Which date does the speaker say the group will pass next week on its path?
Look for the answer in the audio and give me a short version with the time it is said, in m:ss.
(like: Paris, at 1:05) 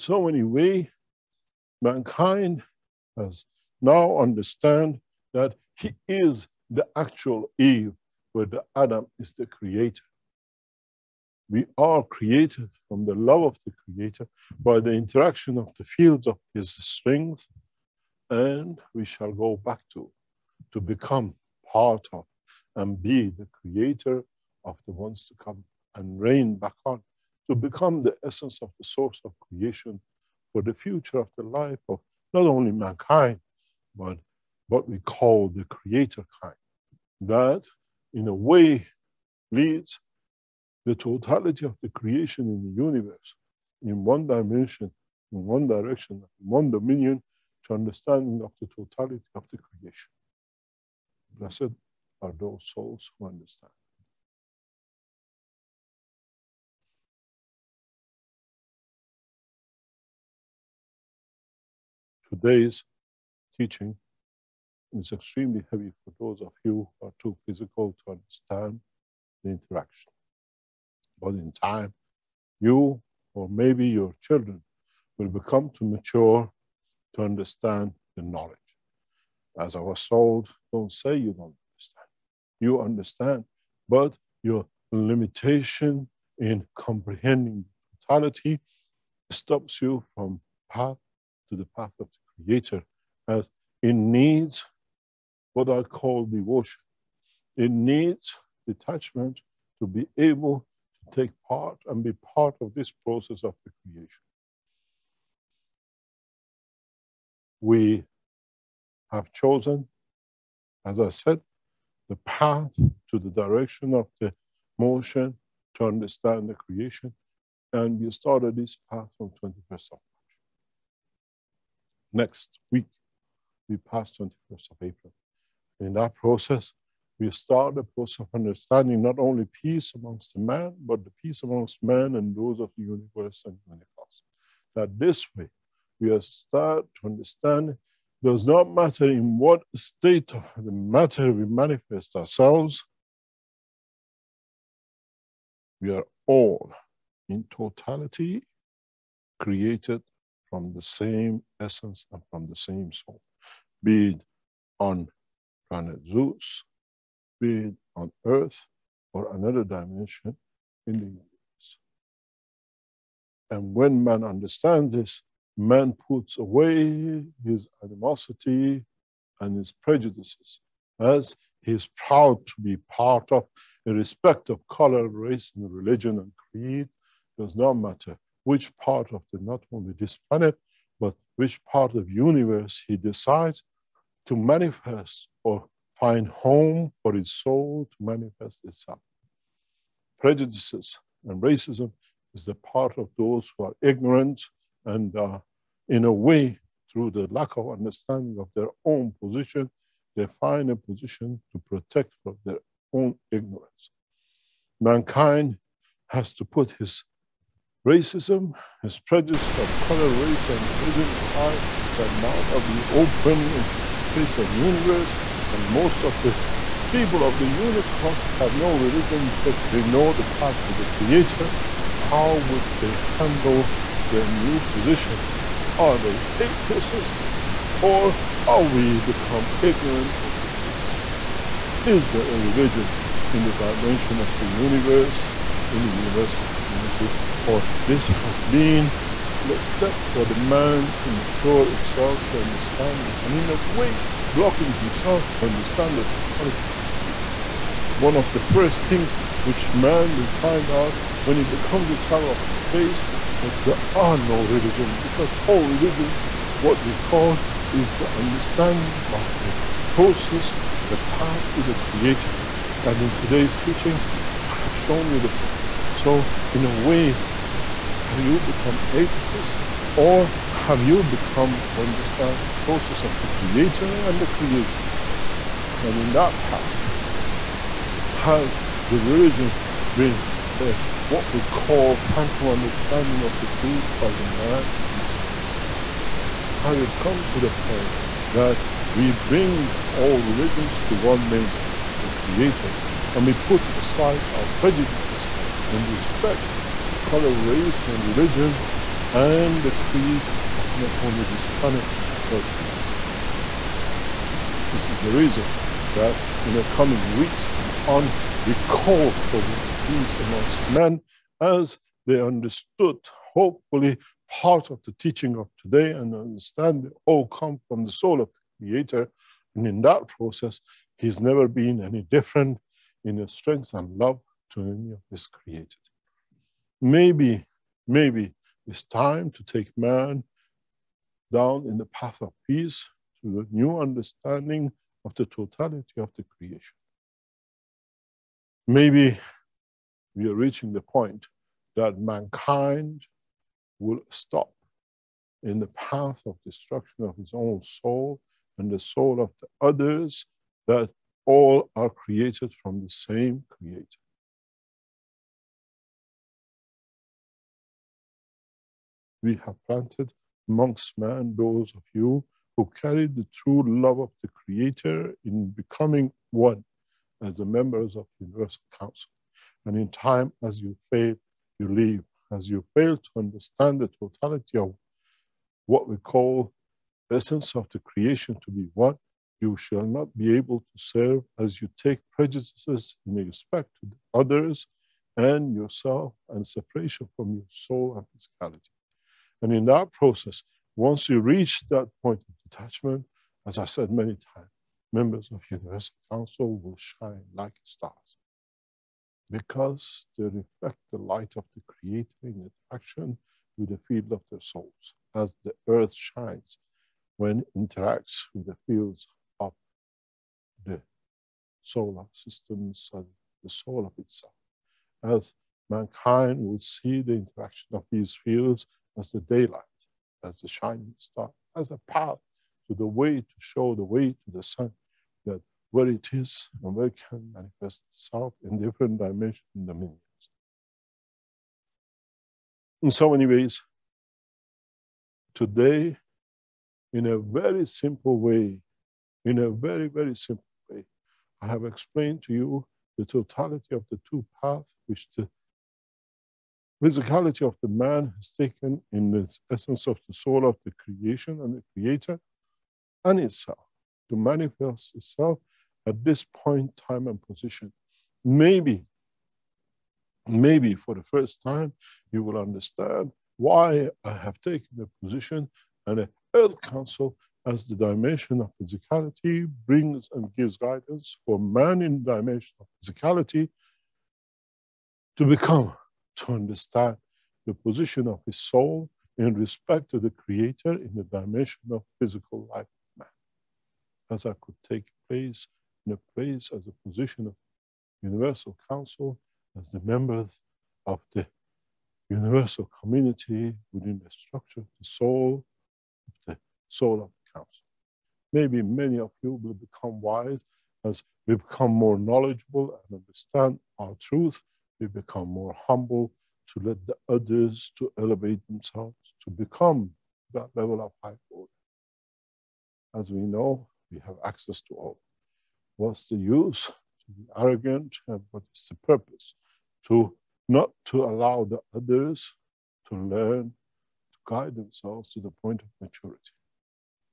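21st of April, at 2:04.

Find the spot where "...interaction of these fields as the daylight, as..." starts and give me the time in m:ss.
6:57.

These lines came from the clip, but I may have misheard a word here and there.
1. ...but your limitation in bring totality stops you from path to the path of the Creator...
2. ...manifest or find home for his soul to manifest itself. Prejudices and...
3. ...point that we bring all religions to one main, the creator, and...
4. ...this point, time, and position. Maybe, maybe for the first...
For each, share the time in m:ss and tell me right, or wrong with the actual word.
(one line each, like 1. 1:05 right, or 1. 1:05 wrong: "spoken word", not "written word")
1. 1:23 wrong: "comprehending", not "bring"
2. 3:04 right
3. 4:47 right
4. 7:36 right.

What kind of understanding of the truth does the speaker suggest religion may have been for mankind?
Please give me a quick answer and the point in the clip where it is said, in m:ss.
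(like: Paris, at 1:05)
phantom understanding, at 4:41.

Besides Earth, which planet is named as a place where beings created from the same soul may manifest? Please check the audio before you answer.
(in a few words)
Zeus.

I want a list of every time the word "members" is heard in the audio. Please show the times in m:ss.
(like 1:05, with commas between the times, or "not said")
6:07, 6:34, 8:09.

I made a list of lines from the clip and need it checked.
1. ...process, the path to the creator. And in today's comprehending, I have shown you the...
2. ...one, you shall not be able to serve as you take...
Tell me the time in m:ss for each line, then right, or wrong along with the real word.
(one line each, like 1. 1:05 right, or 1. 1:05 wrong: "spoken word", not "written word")
1. 4:19 wrong: "teaching", not "comprehending"
2. 6:18 right.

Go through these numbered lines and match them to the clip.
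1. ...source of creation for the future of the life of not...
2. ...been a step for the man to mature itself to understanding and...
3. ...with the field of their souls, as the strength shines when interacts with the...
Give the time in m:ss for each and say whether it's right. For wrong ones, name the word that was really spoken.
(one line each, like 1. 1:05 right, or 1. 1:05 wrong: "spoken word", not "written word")
1. 0:28 right
2. 3:58 right
3. 6:43 wrong: "earth", not "strength".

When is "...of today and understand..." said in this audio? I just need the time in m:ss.
5:15.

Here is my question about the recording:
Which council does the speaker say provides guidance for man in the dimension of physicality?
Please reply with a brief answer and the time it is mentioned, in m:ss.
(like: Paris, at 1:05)
Earth Council, at 7:46.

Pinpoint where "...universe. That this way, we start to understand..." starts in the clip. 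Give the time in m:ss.
2:13.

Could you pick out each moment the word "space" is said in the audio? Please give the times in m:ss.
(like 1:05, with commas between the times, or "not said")
3:33, 4:12.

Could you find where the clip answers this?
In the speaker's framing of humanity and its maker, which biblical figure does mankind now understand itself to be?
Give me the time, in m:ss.
0:07.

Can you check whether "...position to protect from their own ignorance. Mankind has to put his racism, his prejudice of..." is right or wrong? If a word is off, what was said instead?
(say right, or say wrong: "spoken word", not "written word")
right.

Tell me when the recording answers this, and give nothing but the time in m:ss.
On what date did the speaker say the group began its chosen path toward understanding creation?
1:59.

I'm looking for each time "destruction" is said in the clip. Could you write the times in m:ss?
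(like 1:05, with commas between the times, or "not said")
5:46.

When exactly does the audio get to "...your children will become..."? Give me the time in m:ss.
1:13.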